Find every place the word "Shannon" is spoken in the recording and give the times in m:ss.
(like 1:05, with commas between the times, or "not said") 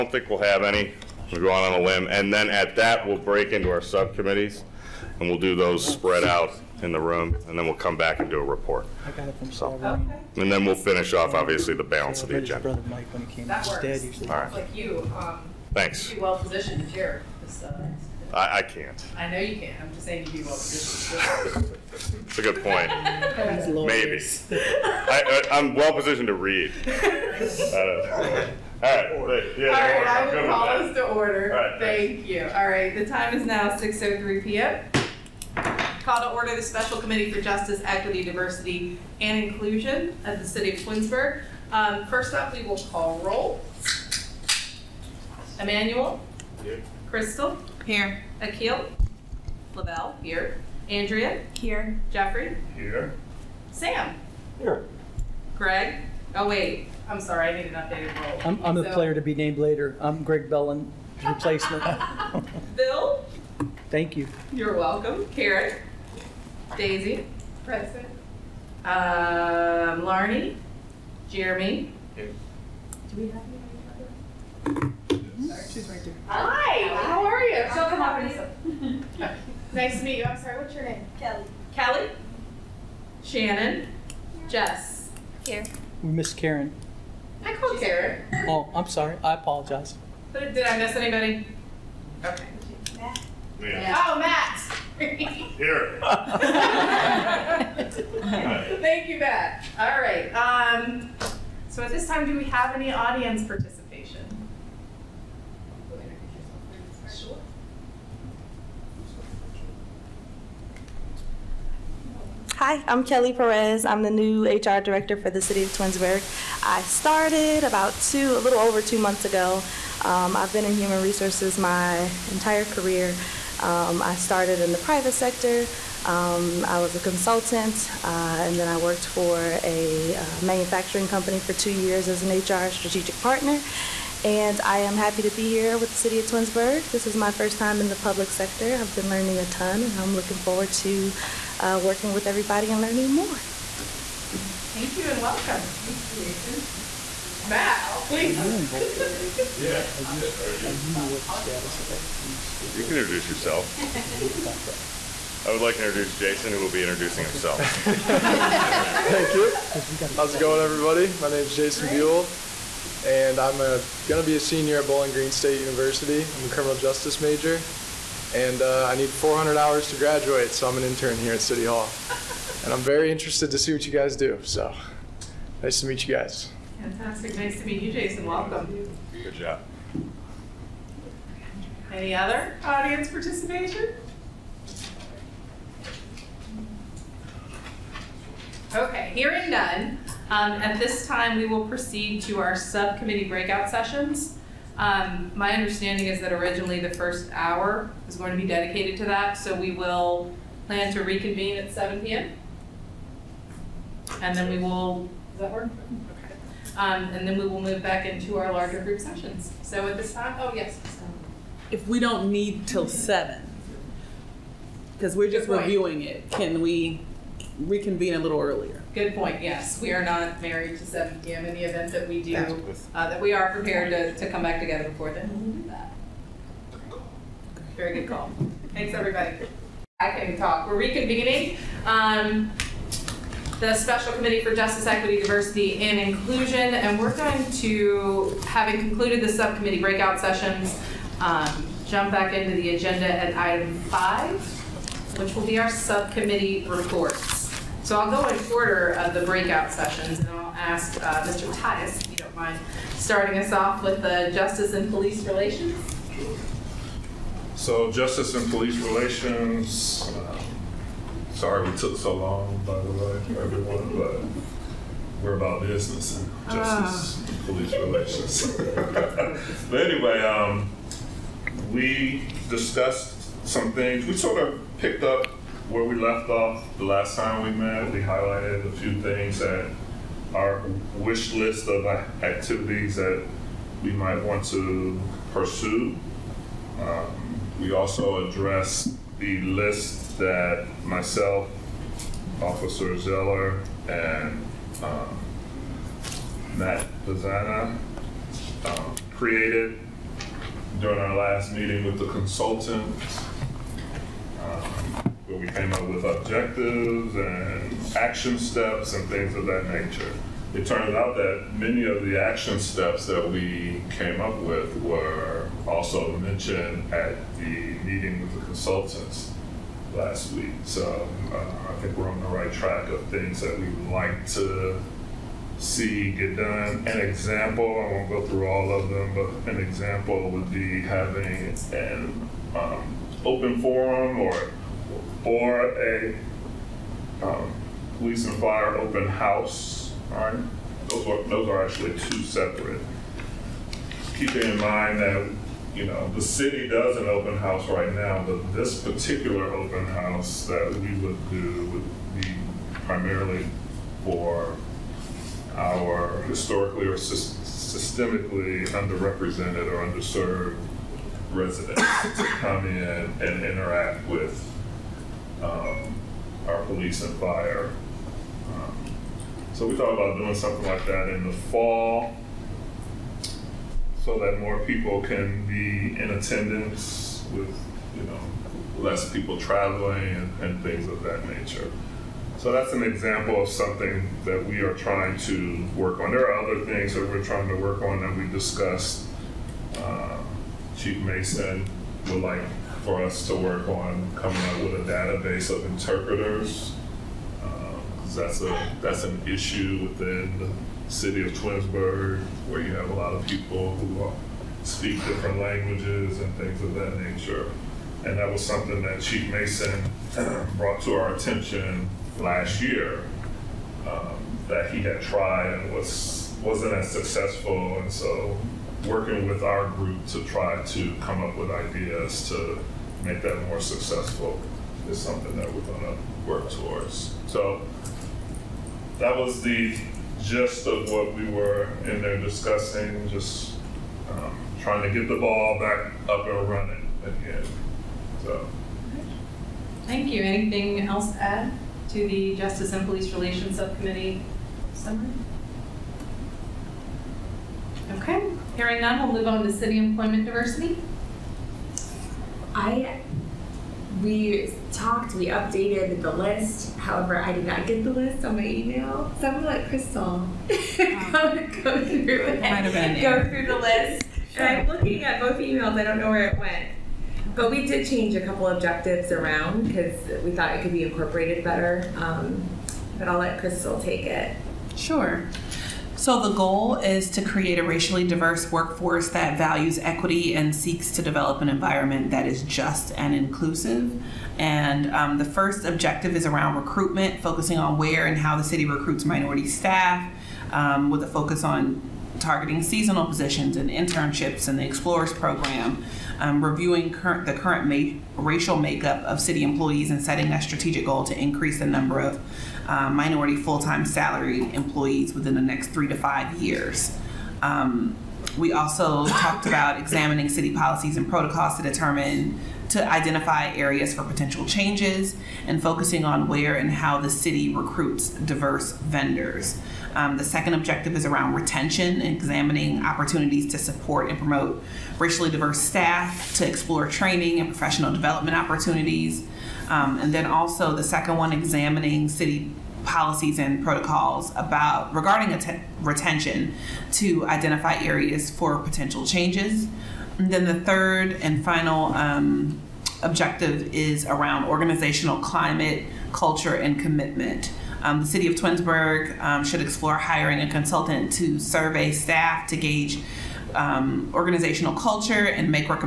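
1:23.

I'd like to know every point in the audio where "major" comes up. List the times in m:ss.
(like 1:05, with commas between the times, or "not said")
2:47.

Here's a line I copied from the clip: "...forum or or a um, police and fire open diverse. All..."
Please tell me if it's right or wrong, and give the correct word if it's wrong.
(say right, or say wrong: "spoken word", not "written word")
wrong: "house", not "diverse".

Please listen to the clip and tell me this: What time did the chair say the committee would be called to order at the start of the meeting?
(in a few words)
6:03 PM.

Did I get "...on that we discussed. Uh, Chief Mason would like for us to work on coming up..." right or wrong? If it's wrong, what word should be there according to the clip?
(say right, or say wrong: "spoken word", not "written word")
right.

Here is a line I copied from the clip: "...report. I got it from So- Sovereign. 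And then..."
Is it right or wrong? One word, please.
right.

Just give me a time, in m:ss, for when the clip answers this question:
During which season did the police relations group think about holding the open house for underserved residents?
6:11.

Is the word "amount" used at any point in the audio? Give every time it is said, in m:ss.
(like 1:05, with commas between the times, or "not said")
not said.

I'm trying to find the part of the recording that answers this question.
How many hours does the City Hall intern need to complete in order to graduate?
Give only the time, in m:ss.
2:49.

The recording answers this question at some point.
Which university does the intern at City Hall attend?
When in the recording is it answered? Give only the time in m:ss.
2:44.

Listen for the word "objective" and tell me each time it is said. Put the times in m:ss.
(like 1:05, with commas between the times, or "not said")
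5:06, 7:48, 8:05, 8:40, 9:03.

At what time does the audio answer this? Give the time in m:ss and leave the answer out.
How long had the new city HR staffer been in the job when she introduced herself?
1:58.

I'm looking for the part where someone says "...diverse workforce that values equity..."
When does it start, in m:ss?
7:58.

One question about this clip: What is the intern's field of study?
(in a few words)
criminal justice.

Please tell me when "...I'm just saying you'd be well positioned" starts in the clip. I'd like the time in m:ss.
0:19.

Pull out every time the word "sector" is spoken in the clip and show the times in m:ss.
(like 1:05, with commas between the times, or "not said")
2:05, 2:18.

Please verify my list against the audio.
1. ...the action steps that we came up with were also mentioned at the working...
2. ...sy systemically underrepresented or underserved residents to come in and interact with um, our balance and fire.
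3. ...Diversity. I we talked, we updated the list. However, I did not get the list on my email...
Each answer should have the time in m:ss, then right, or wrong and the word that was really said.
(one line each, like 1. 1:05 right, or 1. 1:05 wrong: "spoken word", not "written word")
1. 5:12 wrong: "meeting", not "working"
2. 5:56 wrong: "police", not "balance"
3. 7:30 right.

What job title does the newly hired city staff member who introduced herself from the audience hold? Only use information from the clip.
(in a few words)
HR director.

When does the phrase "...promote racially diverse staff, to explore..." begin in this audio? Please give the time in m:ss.
8:44.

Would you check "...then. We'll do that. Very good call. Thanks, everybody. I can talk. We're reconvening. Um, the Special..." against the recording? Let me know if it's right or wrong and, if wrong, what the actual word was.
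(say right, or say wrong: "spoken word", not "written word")
right.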